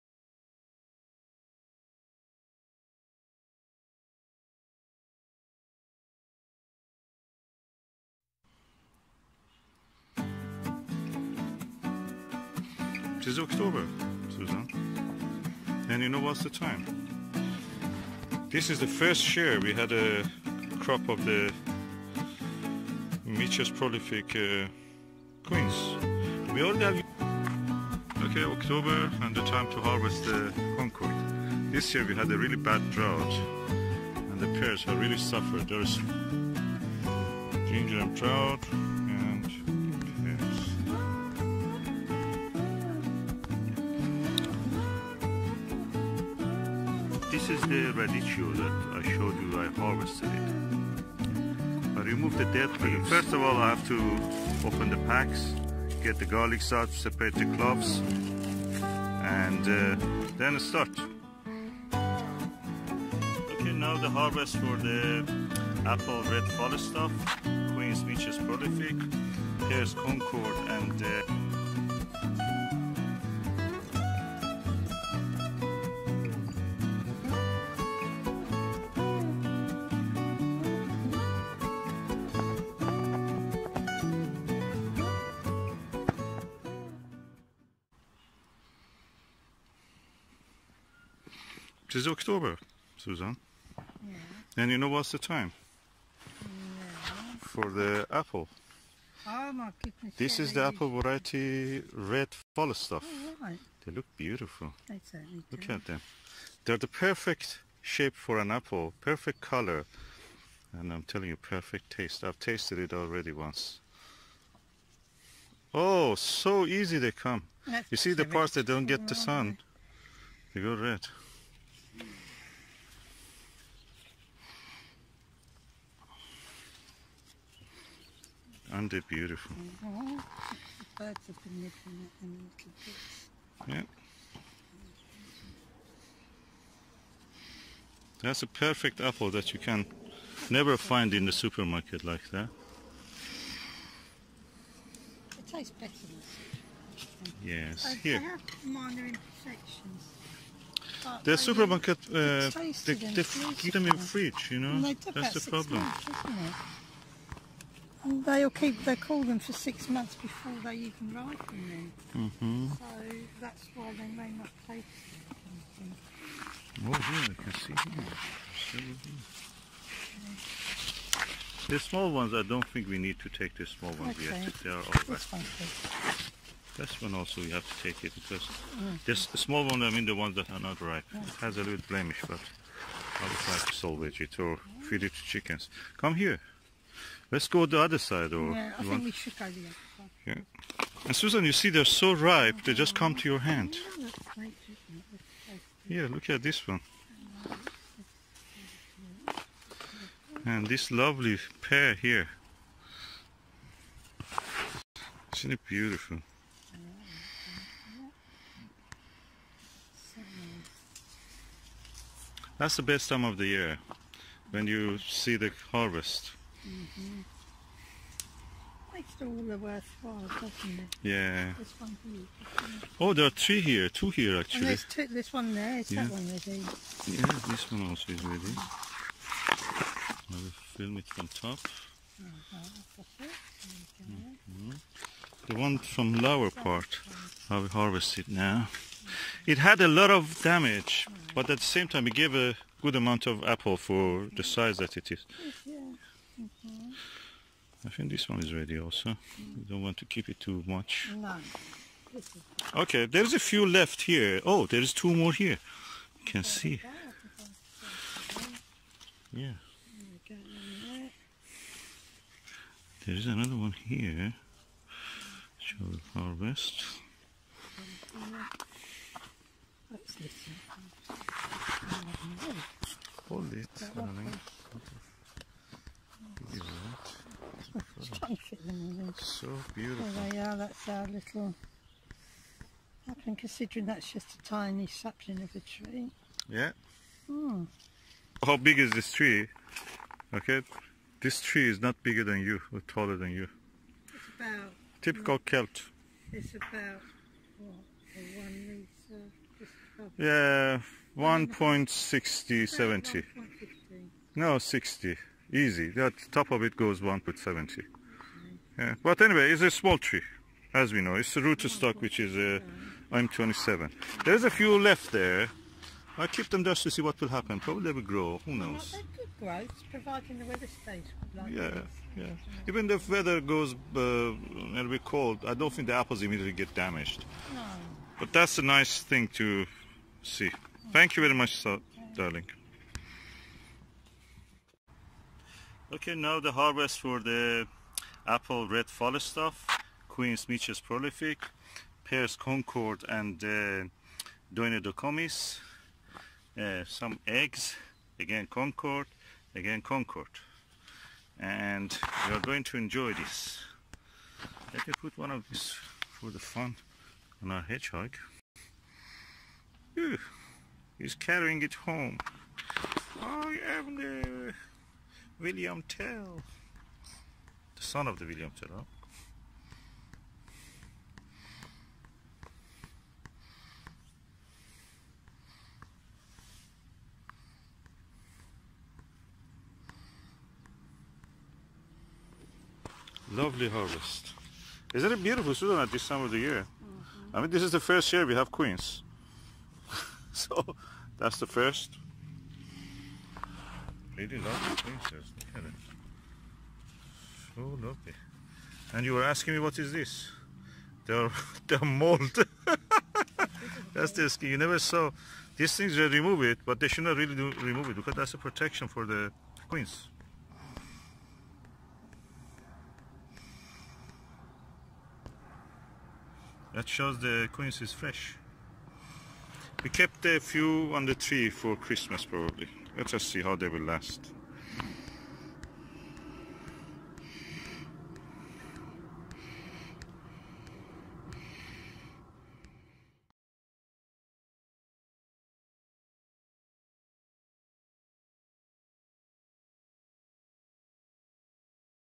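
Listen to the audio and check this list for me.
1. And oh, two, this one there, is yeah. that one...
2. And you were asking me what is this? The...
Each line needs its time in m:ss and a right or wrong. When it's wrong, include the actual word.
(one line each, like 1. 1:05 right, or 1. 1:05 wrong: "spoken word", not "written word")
1. 3:44 right
2. 6:38 right.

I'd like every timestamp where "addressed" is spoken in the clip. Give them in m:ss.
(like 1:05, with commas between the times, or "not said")
not said.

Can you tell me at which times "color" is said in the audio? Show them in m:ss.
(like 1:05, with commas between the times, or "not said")
1:49.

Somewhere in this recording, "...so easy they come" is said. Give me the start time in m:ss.
1:56.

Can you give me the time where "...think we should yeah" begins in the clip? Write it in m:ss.
3:08.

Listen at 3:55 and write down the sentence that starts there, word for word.
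The one from lower part, I will harvest it now.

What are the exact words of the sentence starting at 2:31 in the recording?
The supermarket, uh, they, they keep them in fridge, you know?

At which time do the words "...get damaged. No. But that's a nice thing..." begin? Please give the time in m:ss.
5:26.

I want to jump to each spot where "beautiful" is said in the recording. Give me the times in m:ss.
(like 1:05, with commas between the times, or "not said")
1:44, 2:09, 3:25, 4:39, 6:25.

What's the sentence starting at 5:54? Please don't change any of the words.
Let me put one of these for the fun on our hedgehog.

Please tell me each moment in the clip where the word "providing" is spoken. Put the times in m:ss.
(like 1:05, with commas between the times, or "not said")
5:19.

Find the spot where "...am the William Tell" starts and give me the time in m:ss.
6:03.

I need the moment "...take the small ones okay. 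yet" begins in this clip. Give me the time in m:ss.
2:53.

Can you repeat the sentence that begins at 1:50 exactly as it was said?
And I'm telling you, perfect taste.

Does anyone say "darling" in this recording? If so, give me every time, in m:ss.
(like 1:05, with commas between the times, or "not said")
4:33, 5:32.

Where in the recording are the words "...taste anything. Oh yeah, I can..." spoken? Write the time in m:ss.
2:44.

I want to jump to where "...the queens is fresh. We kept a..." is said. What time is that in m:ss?
6:57.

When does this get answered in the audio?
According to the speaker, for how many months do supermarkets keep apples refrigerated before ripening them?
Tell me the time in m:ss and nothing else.
2:39.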